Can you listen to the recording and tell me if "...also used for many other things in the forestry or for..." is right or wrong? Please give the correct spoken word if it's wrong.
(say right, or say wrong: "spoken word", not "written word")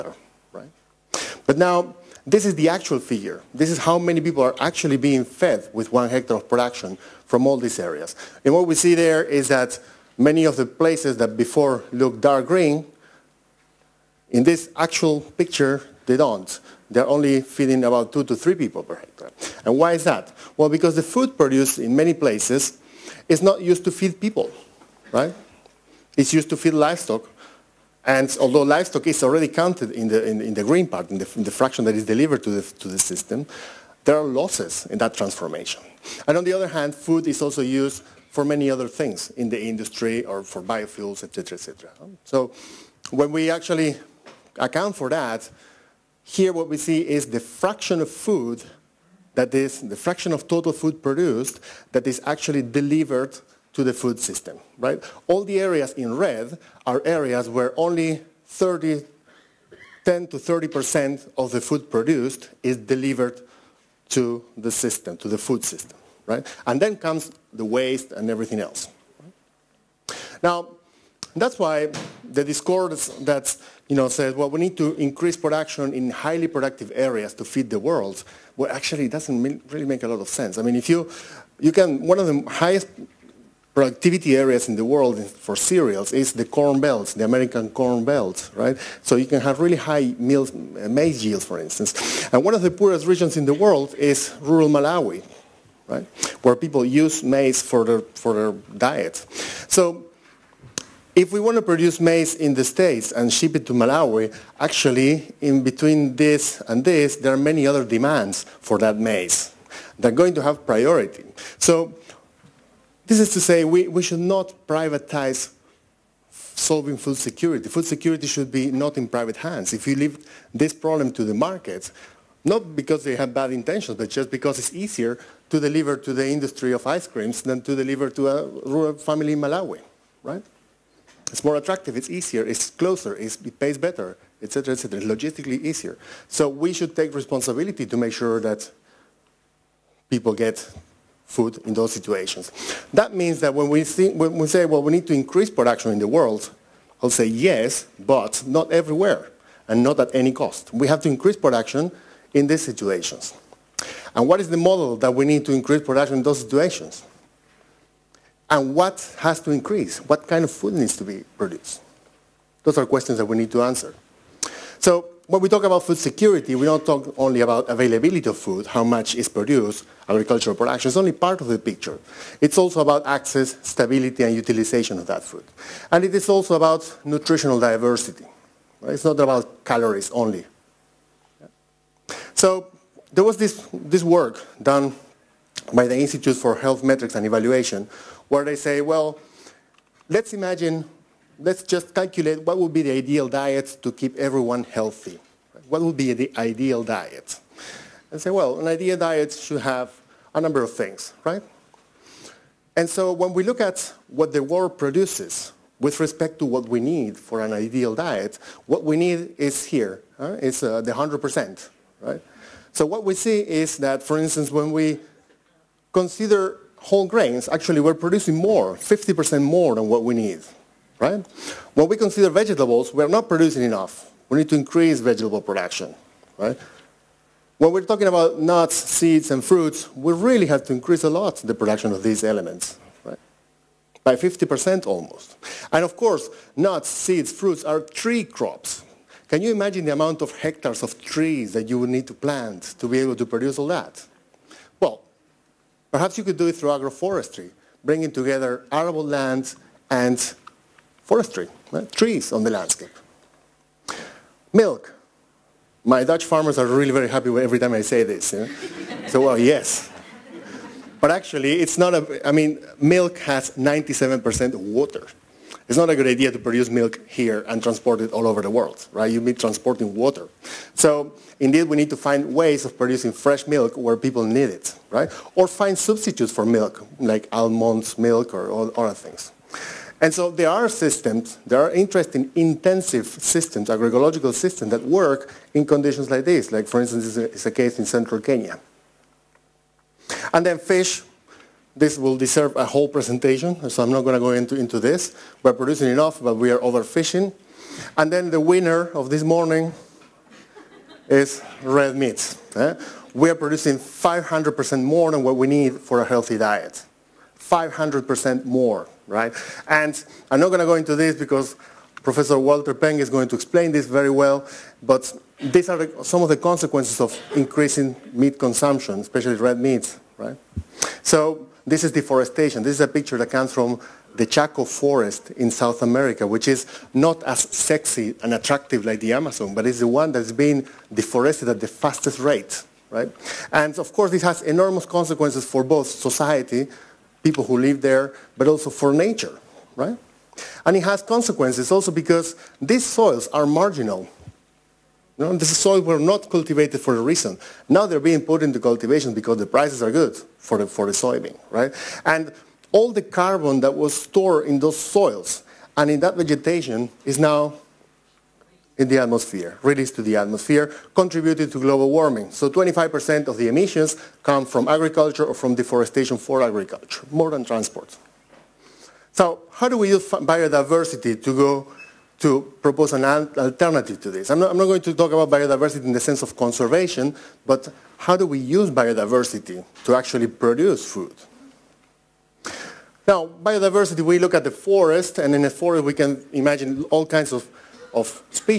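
wrong: "industry", not "forestry".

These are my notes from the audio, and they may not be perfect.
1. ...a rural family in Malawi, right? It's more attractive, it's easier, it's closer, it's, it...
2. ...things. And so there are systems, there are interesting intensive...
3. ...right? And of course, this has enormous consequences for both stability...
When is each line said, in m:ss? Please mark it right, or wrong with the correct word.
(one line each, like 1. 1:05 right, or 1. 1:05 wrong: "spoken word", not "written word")
1. 2:08 right
2. 4:38 right
3. 5:32 wrong: "society", not "stability".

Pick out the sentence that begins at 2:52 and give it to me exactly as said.
It's also about access, stability, and utilization of that food.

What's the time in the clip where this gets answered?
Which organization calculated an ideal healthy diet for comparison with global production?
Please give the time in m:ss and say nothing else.
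3:05.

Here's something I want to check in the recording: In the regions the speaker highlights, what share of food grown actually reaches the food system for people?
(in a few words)
10 to 30%.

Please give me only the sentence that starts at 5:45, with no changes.
You know, these soils were not cultivated for a reason.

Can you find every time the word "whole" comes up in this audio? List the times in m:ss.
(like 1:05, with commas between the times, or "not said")
3:36, 4:52.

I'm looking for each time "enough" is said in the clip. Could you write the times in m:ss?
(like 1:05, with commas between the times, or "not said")
3:43, 4:55.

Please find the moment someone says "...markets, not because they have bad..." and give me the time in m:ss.
2:01.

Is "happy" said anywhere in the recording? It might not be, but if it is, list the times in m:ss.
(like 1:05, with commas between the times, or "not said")
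4:17.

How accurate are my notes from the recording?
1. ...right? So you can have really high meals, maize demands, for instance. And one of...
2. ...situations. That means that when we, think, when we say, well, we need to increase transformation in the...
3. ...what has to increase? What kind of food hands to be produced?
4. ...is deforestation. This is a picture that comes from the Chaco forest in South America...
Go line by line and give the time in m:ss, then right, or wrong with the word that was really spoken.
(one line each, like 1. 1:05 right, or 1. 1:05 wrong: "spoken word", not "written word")
1. 1:28 wrong: "yields", not "demands"
2. 2:21 wrong: "production", not "transformation"
3. 2:38 wrong: "needs", not "hands"
4. 5:21 right.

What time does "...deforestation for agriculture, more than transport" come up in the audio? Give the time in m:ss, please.
6:05.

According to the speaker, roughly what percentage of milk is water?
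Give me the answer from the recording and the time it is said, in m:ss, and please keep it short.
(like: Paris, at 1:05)
97%, at 4:23.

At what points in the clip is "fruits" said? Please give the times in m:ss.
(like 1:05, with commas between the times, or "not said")
3:49, 3:57.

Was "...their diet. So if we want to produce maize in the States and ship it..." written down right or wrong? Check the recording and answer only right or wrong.
right.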